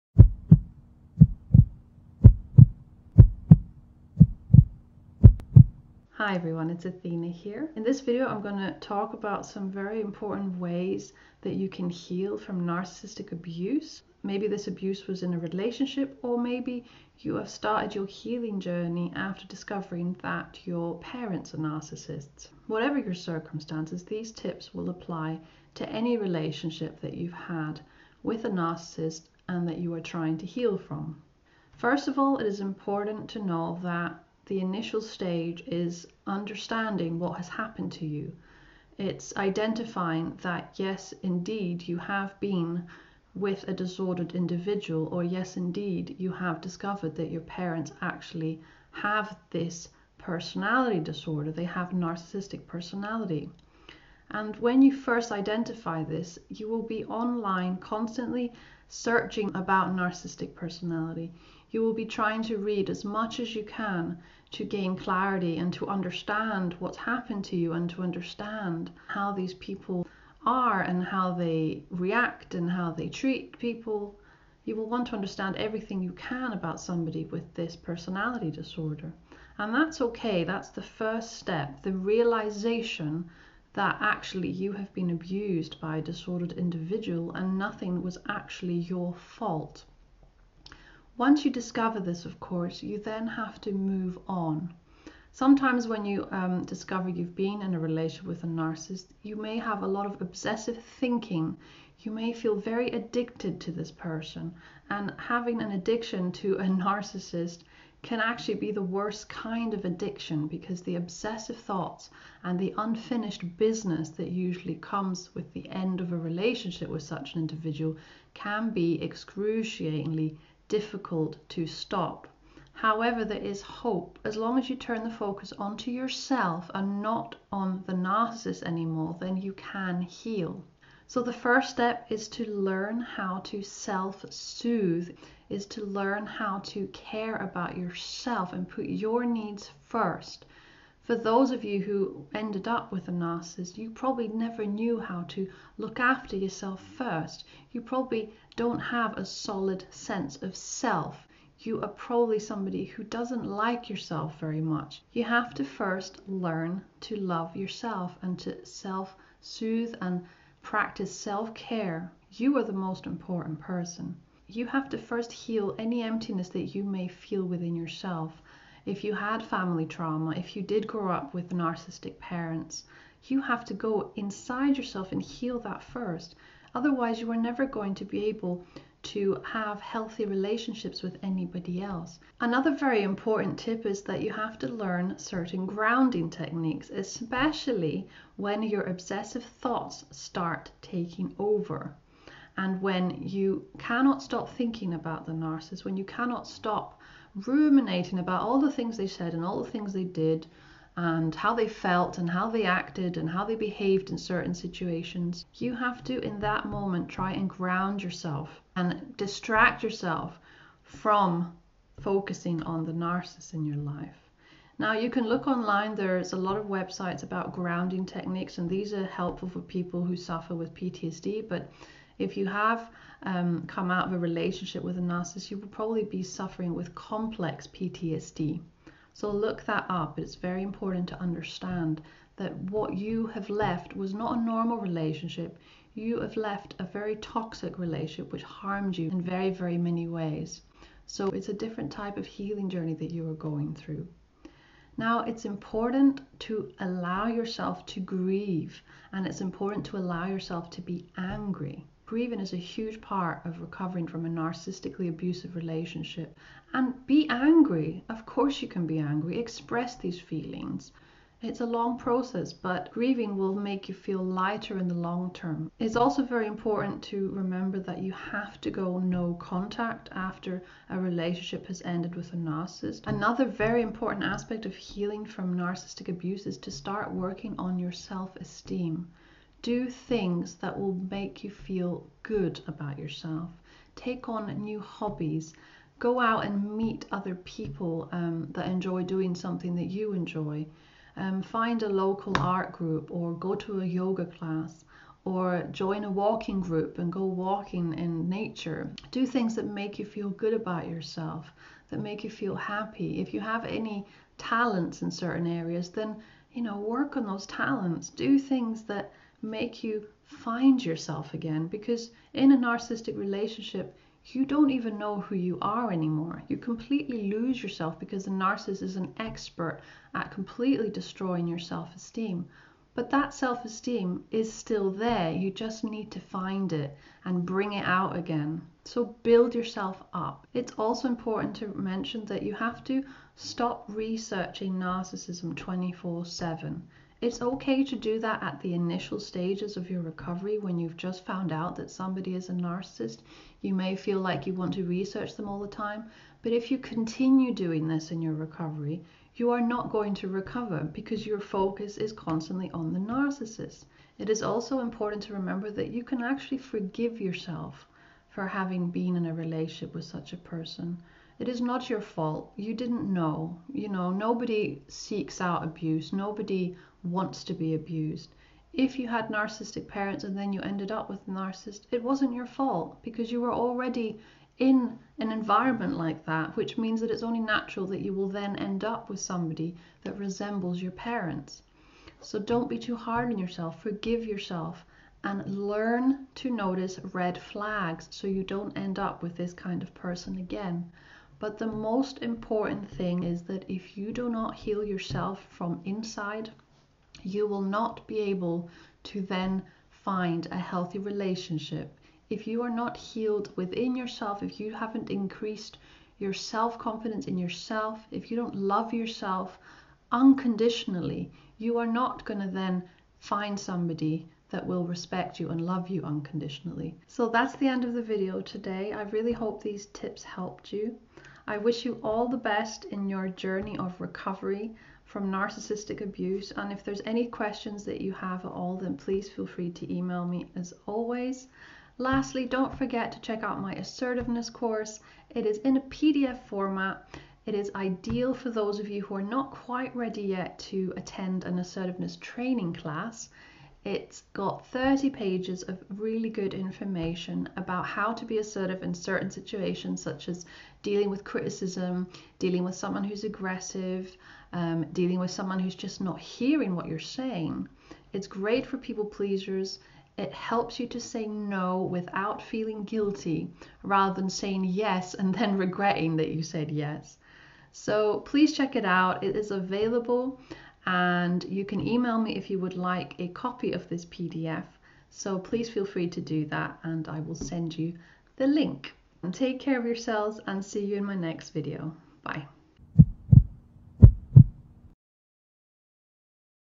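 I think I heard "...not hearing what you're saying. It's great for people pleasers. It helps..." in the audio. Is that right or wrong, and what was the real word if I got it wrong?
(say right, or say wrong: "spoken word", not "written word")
right.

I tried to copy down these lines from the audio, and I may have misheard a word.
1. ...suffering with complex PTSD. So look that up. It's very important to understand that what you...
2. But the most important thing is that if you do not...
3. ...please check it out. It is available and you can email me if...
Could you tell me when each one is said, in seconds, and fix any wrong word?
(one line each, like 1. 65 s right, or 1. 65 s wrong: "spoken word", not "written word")
1. 226 s right
2. 391 s right
3. 468 s right.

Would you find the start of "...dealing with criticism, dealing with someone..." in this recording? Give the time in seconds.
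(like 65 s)
450 s.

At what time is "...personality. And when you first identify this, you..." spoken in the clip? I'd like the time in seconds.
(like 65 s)
52 s.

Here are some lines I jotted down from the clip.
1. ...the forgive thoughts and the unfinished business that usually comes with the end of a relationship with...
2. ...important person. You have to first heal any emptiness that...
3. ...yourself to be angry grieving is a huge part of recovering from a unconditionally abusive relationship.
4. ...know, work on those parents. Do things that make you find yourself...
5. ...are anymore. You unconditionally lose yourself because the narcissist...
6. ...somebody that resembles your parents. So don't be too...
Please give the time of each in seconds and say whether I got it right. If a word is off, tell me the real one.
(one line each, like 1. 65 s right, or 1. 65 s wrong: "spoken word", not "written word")
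1. 110 s wrong: "obsessive", not "forgive"
2. 163 s right
3. 250 s wrong: "narcissistically", not "unconditionally"
4. 306 s wrong: "talents", not "parents"
5. 315 s wrong: "completely", not "unconditionally"
6. 379 s right.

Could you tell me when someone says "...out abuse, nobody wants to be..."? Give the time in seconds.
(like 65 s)
365 s.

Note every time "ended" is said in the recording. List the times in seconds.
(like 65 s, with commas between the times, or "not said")
142 s, 271 s, 370 s.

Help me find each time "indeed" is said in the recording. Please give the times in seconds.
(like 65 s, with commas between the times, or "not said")
41 s, 45 s.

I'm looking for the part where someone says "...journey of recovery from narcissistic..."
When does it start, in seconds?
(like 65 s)
423 s.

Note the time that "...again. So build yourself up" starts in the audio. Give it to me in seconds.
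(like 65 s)
328 s.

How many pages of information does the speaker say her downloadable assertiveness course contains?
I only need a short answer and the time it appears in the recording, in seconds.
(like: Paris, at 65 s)
30, at 444 s.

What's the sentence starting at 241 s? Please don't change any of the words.
So it's a different type of healing journey that you are going through.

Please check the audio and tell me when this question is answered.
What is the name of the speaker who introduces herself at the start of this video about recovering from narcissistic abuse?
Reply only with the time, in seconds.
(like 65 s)
6 s.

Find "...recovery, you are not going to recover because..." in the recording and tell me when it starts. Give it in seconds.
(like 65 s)
348 s.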